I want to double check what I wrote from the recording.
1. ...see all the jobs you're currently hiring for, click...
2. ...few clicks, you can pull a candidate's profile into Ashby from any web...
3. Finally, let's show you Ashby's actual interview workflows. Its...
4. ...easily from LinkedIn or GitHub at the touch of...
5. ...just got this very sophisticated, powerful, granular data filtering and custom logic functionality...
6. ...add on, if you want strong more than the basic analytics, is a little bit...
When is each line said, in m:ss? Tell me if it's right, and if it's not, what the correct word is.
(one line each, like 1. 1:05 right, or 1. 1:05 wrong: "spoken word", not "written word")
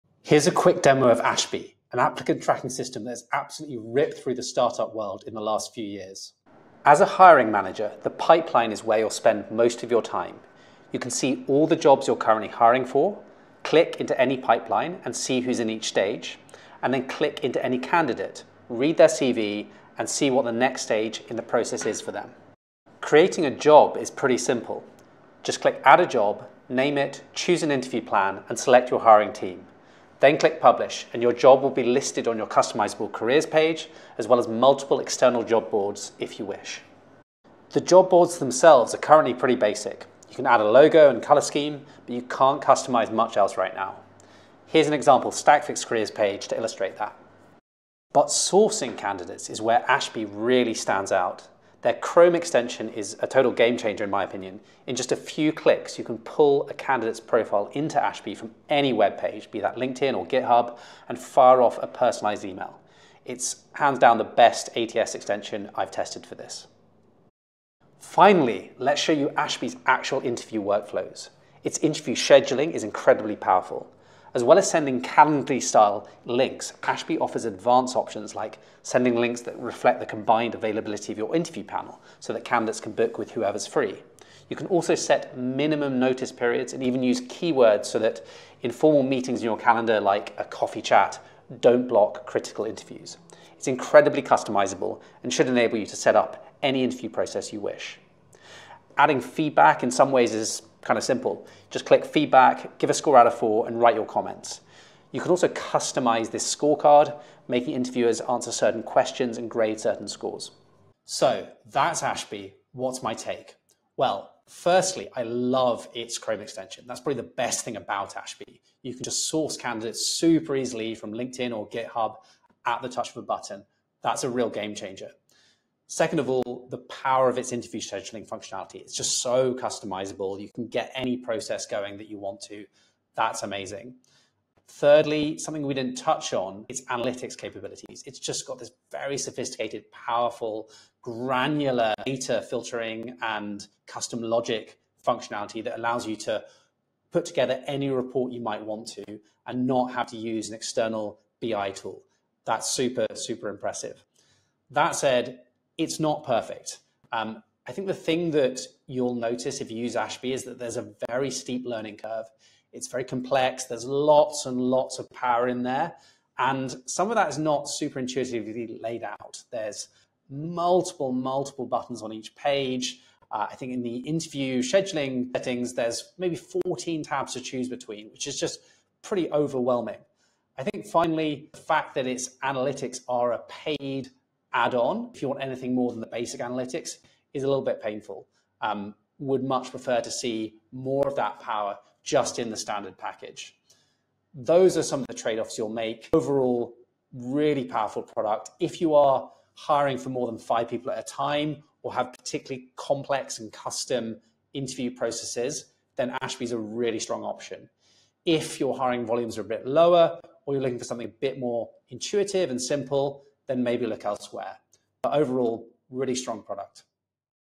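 1. 0:11 right
2. 0:55 right
3. 1:07 right
4. 2:00 right
5. 2:18 right
6. 3:04 wrong: "anything", not "strong".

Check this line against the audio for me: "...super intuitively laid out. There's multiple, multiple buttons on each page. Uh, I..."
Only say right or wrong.
right.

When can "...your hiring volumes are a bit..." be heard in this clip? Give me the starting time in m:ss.
3:28.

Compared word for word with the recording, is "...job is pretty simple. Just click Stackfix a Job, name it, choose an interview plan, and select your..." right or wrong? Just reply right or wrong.
wrong.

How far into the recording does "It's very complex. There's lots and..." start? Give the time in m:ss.
2:42.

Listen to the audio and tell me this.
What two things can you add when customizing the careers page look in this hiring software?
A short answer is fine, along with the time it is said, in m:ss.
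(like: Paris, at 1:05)
logo and color scheme, at 0:40.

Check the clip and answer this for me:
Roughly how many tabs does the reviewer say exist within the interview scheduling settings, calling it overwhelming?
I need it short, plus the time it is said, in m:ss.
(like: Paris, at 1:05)
14, at 2:56.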